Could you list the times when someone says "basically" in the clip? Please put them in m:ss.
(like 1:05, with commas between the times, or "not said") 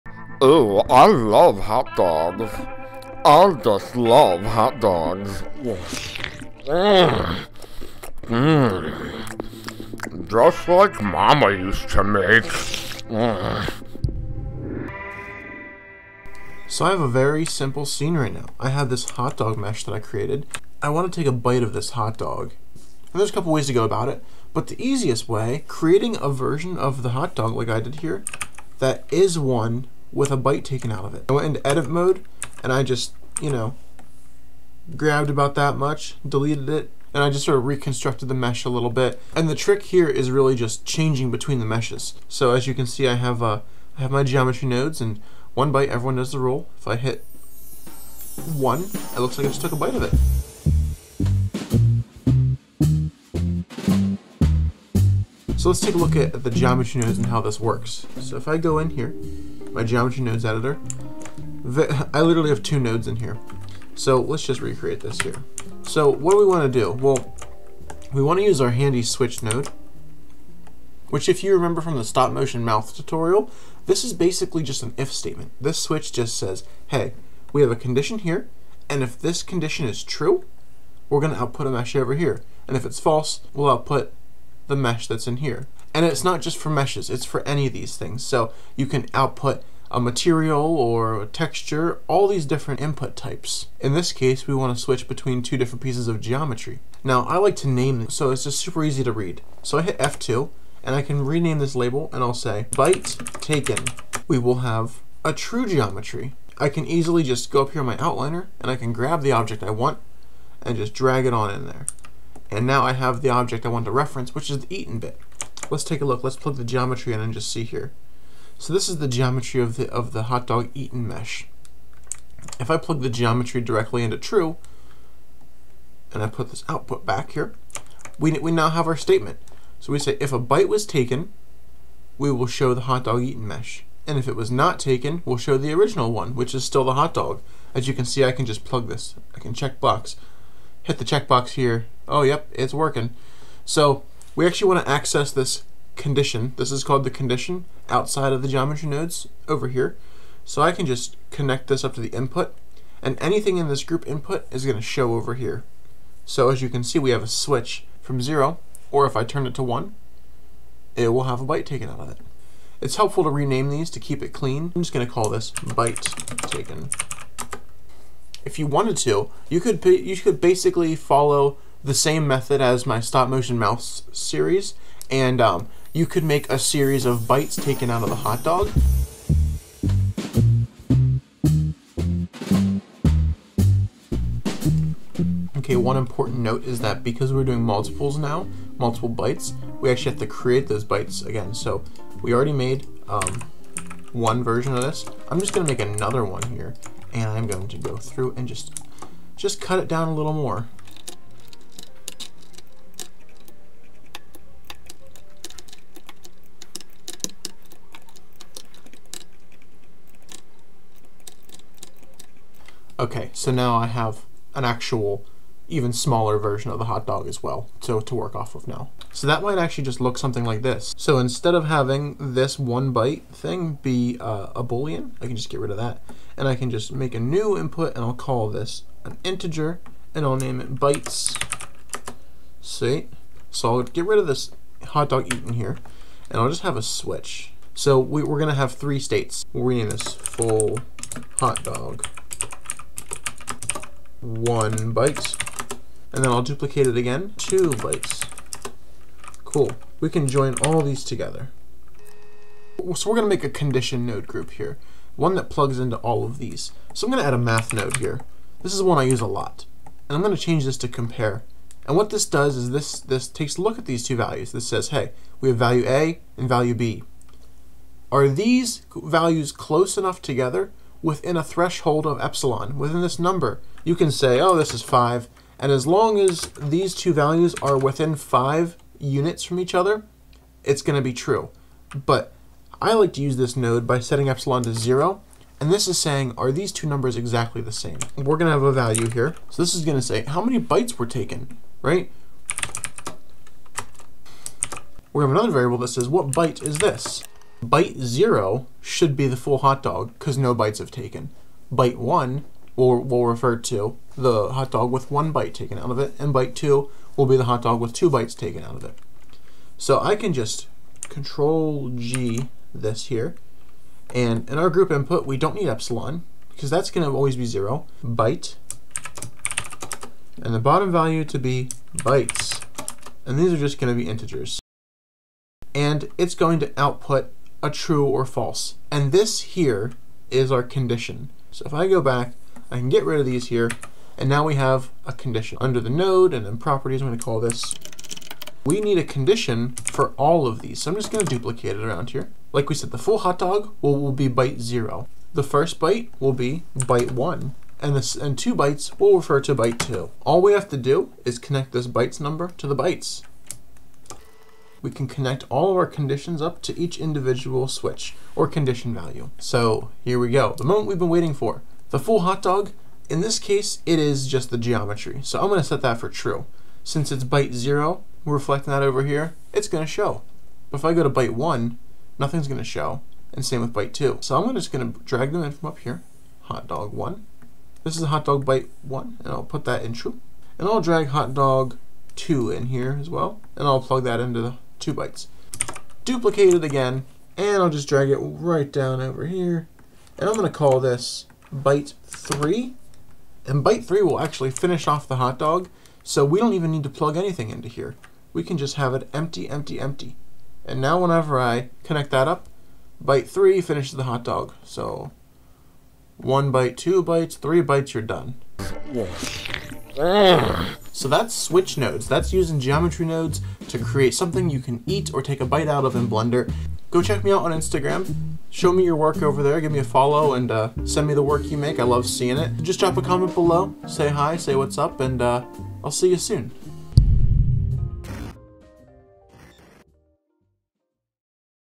1:14, 2:50.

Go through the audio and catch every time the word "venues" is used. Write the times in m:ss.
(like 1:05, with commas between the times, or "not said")
not said.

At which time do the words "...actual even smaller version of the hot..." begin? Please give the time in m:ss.
3:34.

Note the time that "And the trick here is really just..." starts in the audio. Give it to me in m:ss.
0:39.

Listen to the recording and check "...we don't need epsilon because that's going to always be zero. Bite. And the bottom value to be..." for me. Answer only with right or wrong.
right.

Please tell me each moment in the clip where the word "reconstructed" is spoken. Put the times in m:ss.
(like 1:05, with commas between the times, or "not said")
0:37.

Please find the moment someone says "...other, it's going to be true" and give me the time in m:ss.
4:39.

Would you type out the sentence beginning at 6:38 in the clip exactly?
We can just have it empty, empty, empty.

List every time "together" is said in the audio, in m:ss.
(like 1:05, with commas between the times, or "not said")
4:11, 4:30.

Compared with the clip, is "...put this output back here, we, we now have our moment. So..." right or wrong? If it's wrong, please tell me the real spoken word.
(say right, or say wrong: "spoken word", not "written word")
wrong: "statement", not "moment".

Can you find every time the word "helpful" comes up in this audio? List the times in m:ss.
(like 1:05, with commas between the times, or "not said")
2:42.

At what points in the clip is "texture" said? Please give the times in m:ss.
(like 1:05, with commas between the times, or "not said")
1:31.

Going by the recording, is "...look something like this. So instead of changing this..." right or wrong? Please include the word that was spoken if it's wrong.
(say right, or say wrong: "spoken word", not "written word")
wrong: "having", not "changing".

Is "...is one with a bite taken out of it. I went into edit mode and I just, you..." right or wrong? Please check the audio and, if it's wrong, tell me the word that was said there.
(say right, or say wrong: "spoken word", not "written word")
right.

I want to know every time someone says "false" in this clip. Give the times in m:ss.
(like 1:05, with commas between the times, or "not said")
1:22, 5:28.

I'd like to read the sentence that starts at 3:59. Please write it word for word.
We'll rename this full hot dog one bite, And then I'll duplicate it again, two bites.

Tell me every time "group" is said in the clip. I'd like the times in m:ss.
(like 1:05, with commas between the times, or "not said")
2:33, 4:14, 5:14.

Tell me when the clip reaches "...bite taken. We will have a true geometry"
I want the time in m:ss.
1:42.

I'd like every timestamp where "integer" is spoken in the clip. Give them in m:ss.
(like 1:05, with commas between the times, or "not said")
3:49, 5:24.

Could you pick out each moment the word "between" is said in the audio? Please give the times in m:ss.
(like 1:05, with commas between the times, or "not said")
0:41, 1:35.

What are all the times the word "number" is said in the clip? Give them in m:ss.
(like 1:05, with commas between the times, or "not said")
4:33, 4:46, 5:52.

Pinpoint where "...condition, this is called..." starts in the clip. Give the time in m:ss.
2:26.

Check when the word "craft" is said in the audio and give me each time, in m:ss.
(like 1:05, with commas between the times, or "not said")
not said.